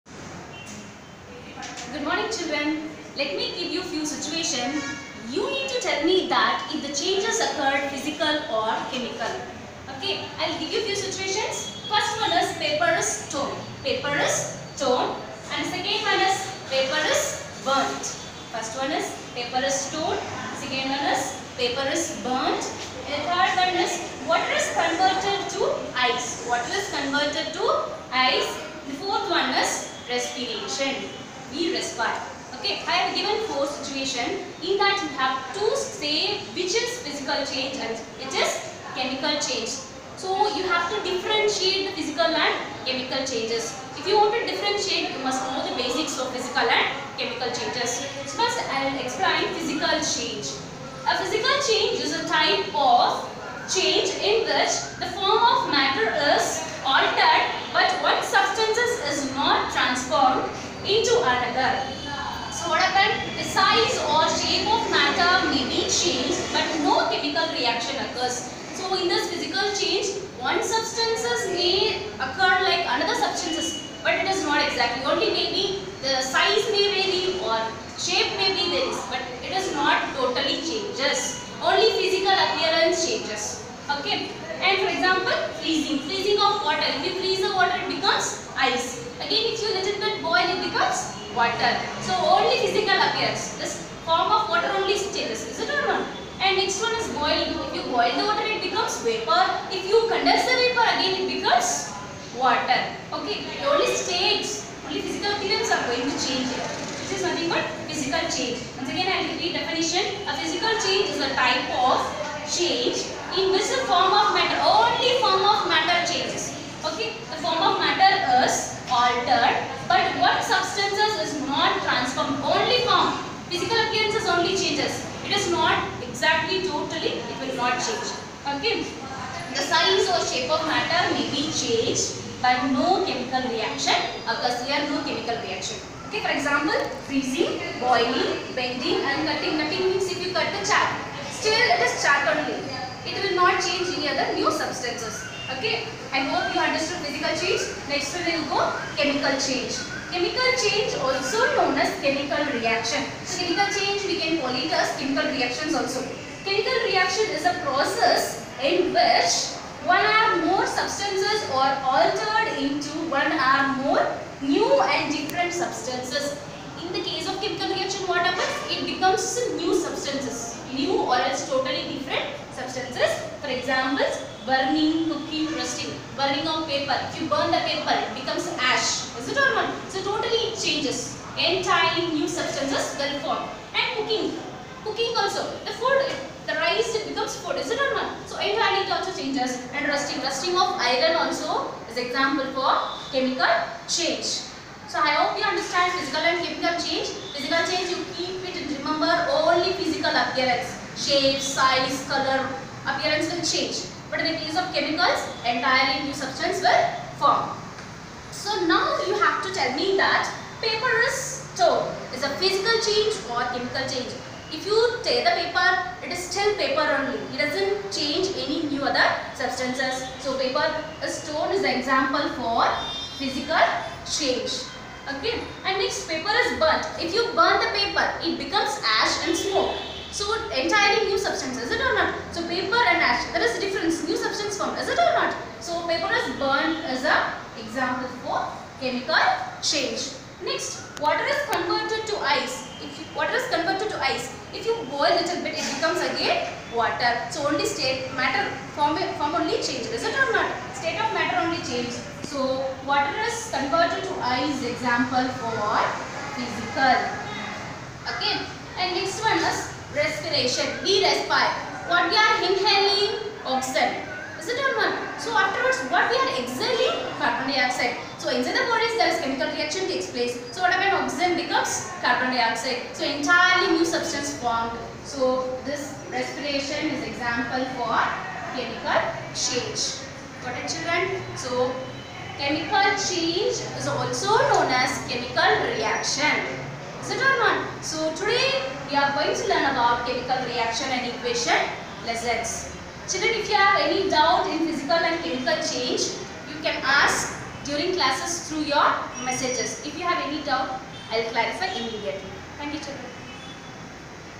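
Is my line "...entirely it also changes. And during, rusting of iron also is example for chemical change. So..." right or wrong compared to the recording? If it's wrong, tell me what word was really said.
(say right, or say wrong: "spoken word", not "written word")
wrong: "rusting", not "during".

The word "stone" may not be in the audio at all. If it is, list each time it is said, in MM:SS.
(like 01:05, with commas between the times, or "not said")
03:31, 03:41.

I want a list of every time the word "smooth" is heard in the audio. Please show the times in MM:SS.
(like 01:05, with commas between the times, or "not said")
not said.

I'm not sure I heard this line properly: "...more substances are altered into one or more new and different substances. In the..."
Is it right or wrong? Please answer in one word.
right.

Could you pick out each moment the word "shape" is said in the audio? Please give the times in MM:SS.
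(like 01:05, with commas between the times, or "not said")
01:18, 02:10, 03:20.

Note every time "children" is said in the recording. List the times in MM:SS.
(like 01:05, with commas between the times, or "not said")
00:02, 04:40, 04:53, 05:02.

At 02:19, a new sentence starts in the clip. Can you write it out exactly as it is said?
Nothing means if you cut the chart, still it is chart only.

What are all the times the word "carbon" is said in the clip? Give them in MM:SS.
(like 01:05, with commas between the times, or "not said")
04:27, 04:32.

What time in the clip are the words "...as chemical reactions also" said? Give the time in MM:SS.
02:34.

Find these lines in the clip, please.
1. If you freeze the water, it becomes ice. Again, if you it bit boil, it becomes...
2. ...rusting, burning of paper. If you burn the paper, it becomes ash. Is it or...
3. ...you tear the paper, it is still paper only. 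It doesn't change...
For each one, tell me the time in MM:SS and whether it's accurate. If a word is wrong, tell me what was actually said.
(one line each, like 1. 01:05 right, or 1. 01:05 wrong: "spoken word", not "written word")
1. 01:26 right
2. 02:55 right
3. 03:34 right.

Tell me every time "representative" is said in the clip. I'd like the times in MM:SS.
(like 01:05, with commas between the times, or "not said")
not said.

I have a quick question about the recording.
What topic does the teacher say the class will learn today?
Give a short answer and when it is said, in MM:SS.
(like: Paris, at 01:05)
Chemical reaction and equation, at 04:50.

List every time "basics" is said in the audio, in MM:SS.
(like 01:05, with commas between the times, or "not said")
00:45.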